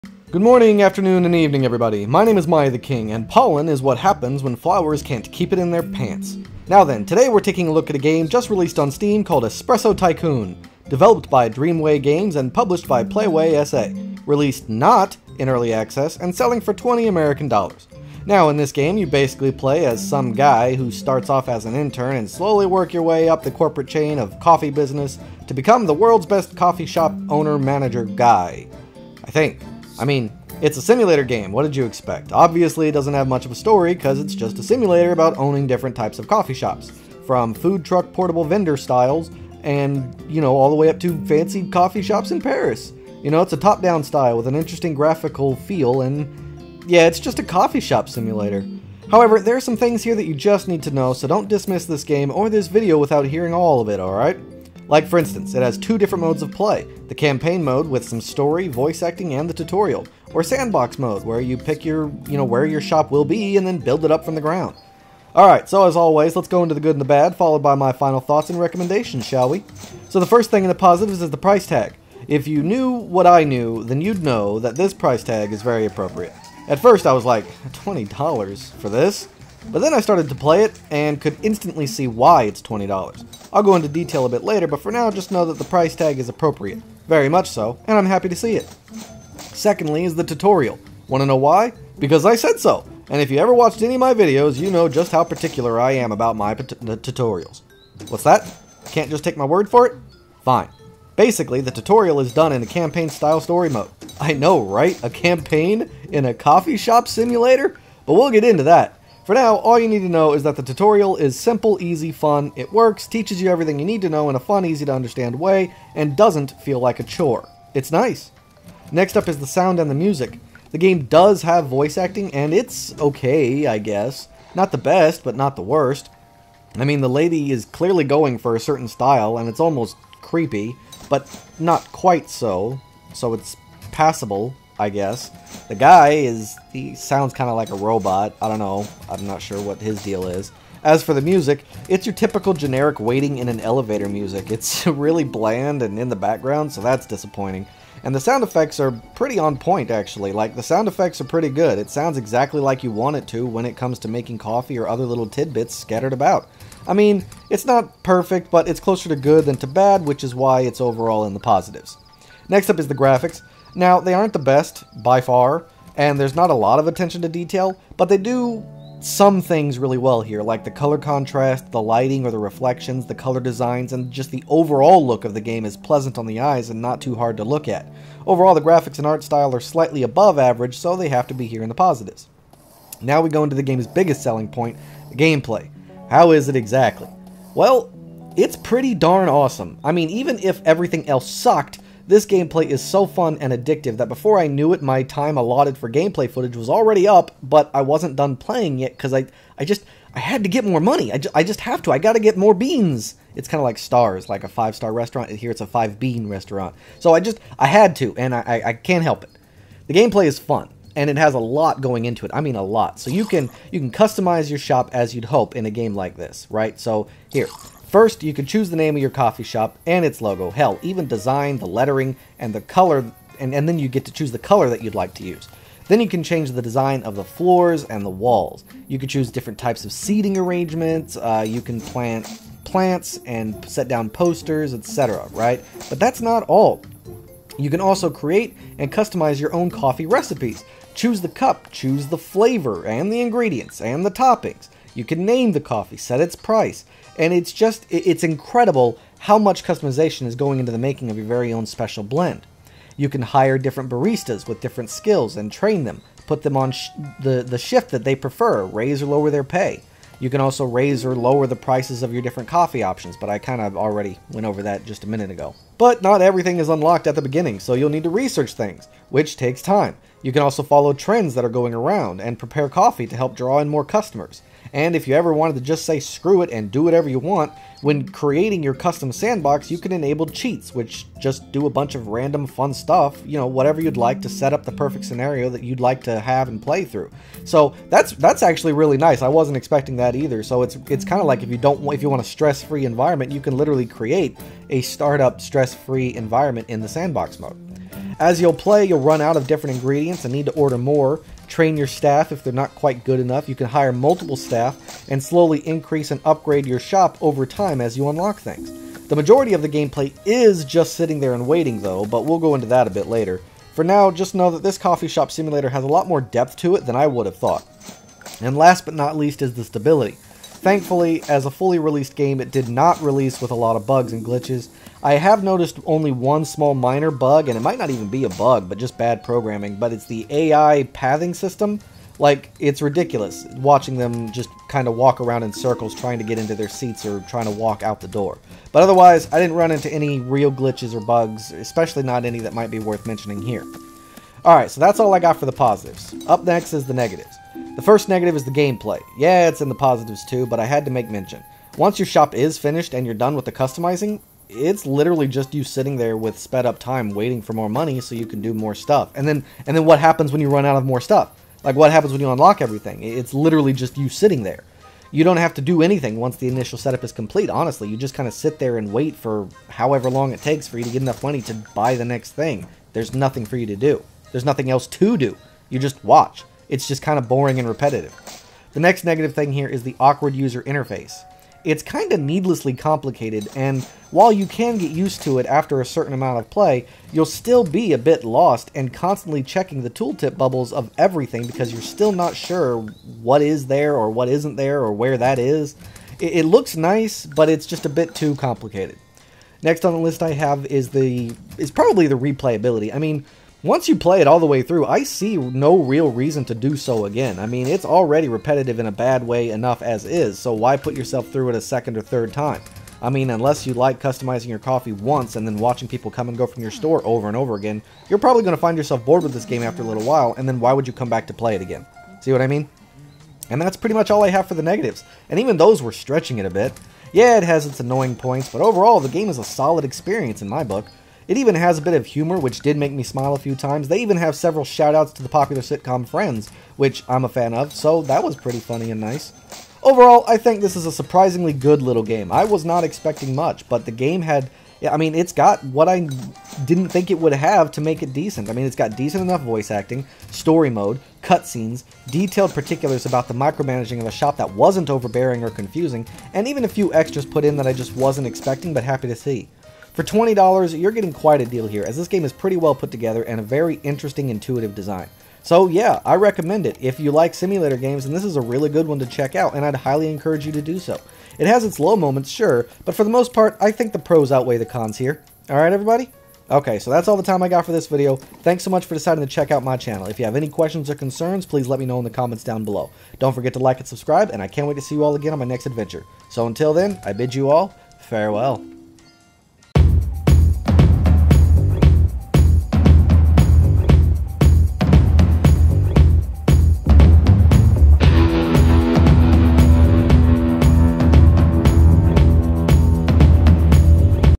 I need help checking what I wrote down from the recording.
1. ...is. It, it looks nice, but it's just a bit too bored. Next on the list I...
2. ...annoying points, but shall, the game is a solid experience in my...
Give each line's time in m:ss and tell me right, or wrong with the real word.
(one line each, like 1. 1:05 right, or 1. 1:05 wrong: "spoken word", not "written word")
1. 6:35 wrong: "complicated", not "bored"
2. 7:07 wrong: "overall", not "shall".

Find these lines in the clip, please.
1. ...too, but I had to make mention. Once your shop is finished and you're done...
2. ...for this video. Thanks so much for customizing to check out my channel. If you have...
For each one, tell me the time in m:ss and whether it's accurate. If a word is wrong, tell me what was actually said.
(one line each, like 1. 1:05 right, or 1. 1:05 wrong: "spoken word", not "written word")
1. 5:50 right
2. 7:57 wrong: "deciding", not "customizing".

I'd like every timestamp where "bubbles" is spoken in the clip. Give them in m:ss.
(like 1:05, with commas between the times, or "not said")
6:30.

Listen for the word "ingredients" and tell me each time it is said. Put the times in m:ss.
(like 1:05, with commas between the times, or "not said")
4:03, 4:59.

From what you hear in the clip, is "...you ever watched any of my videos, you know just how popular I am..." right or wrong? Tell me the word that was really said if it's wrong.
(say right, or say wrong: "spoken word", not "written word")
wrong: "particular", not "popular".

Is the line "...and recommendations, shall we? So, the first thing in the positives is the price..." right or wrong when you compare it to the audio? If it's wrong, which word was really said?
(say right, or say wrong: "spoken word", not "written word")
right.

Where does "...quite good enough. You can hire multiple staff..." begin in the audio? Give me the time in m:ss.
5:02.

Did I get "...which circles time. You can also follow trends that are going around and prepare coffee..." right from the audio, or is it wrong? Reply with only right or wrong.
wrong.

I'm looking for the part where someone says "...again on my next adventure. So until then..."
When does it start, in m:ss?
8:05.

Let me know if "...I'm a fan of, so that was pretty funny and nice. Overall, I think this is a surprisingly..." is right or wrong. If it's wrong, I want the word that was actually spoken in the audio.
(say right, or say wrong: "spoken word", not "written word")
right.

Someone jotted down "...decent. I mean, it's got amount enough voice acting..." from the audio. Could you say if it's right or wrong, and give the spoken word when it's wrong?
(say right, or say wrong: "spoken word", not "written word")
wrong: "decent", not "amount".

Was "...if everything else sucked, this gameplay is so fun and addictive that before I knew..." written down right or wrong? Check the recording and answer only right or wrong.
right.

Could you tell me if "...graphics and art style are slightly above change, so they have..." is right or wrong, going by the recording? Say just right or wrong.
wrong.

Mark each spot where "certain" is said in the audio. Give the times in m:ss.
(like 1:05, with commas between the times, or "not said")
2:08, 6:25.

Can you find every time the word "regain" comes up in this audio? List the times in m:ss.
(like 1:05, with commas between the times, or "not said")
not said.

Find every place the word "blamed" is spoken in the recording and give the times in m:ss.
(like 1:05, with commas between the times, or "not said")
not said.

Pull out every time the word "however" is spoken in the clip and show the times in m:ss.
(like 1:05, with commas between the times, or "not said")
0:49, 6:09.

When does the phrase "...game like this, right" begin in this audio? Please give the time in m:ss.
3:35.